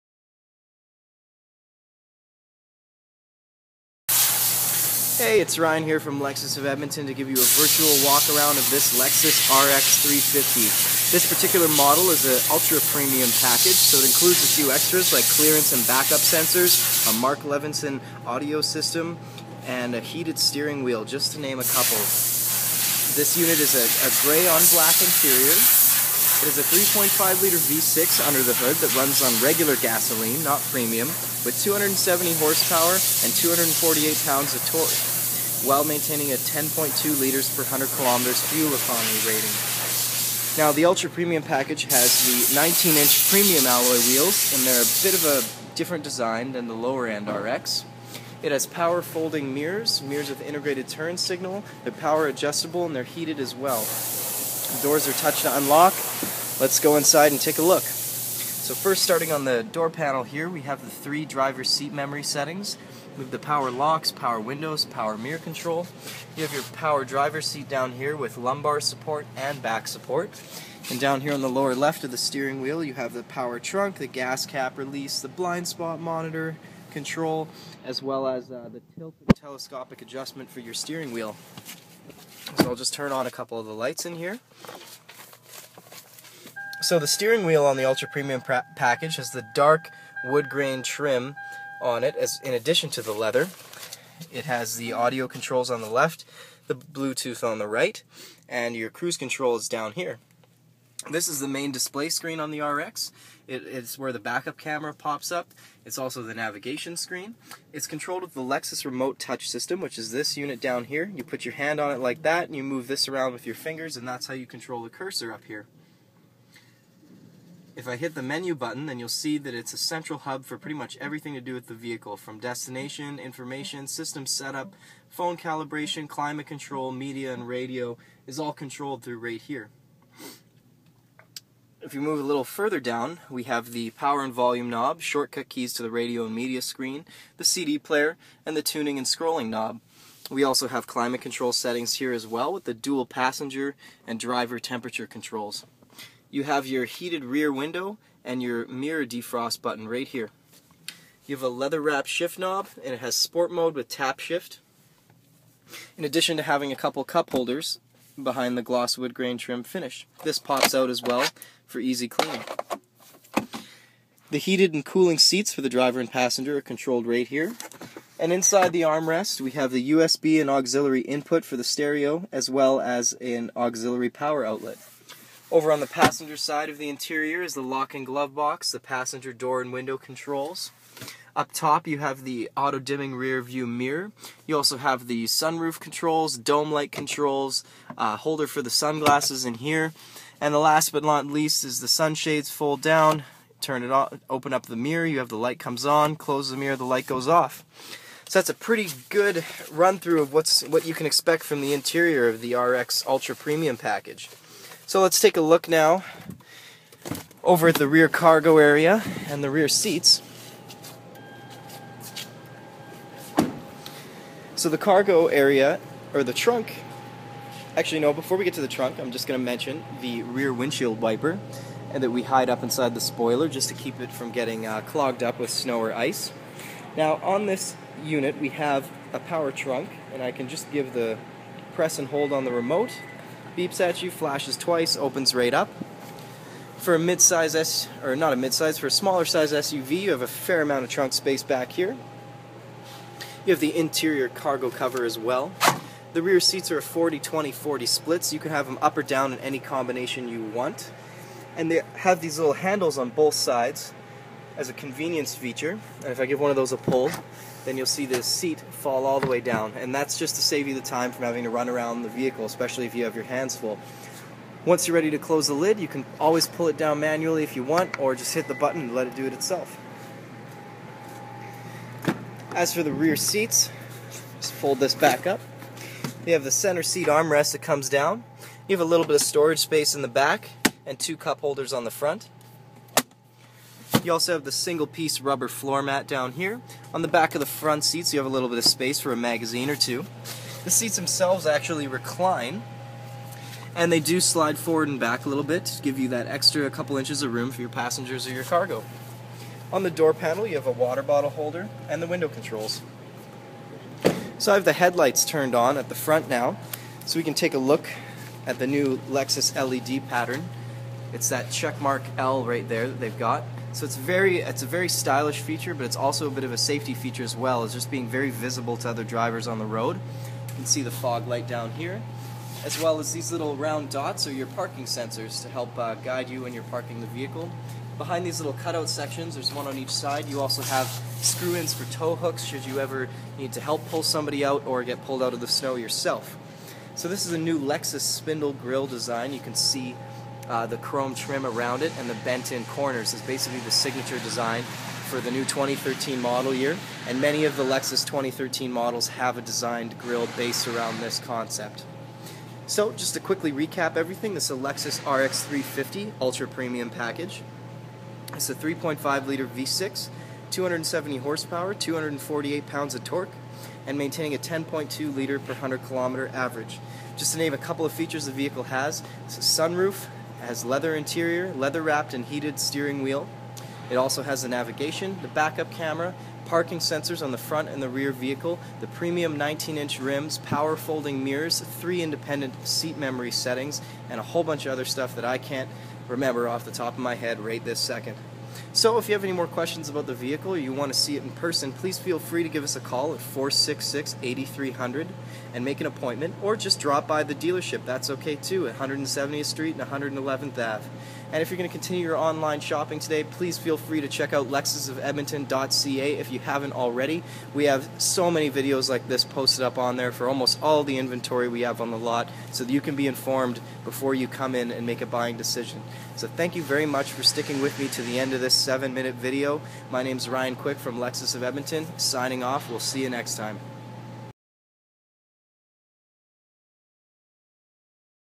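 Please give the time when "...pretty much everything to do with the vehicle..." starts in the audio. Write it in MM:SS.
02:00.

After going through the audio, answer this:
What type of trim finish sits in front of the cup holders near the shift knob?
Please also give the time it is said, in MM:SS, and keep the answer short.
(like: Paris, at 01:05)
Gloss wood grain, at 02:38.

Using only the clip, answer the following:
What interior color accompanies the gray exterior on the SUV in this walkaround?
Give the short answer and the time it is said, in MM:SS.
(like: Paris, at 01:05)
Black, at 00:24.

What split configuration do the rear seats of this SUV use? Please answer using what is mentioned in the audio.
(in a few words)
40/20/40.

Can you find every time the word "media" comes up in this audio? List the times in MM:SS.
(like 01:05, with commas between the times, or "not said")
02:06, 02:16.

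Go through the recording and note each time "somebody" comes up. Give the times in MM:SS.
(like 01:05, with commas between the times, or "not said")
05:34.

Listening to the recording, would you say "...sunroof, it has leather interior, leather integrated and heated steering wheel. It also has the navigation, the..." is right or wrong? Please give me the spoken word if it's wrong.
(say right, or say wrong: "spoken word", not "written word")
wrong: "wrapped", not "integrated".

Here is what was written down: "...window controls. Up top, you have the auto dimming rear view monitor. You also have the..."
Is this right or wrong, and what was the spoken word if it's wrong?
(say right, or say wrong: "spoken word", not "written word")
wrong: "mirror", not "monitor".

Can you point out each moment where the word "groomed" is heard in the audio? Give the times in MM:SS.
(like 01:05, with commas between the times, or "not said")
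not said.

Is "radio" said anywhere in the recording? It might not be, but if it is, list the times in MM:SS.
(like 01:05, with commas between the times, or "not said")
02:07, 02:15.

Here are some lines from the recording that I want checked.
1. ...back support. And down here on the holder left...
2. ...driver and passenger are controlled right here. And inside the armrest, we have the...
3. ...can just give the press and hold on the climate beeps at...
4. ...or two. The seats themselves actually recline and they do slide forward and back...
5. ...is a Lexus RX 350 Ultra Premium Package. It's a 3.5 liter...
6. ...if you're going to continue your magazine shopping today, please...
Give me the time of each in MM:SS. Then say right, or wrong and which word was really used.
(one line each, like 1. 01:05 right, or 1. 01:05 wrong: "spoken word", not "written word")
1. 01:09 wrong: "lower", not "holder"
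2. 02:45 right
3. 03:50 wrong: "remote", not "climate"
4. 04:49 right
5. 05:54 right
6. 06:41 wrong: "online", not "magazine".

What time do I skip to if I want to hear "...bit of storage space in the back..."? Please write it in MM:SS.
04:39.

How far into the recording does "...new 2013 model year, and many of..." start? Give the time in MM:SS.
05:45.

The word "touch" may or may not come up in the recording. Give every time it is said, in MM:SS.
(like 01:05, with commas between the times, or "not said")
00:55, 01:49.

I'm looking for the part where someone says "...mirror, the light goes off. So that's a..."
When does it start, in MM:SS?
03:16.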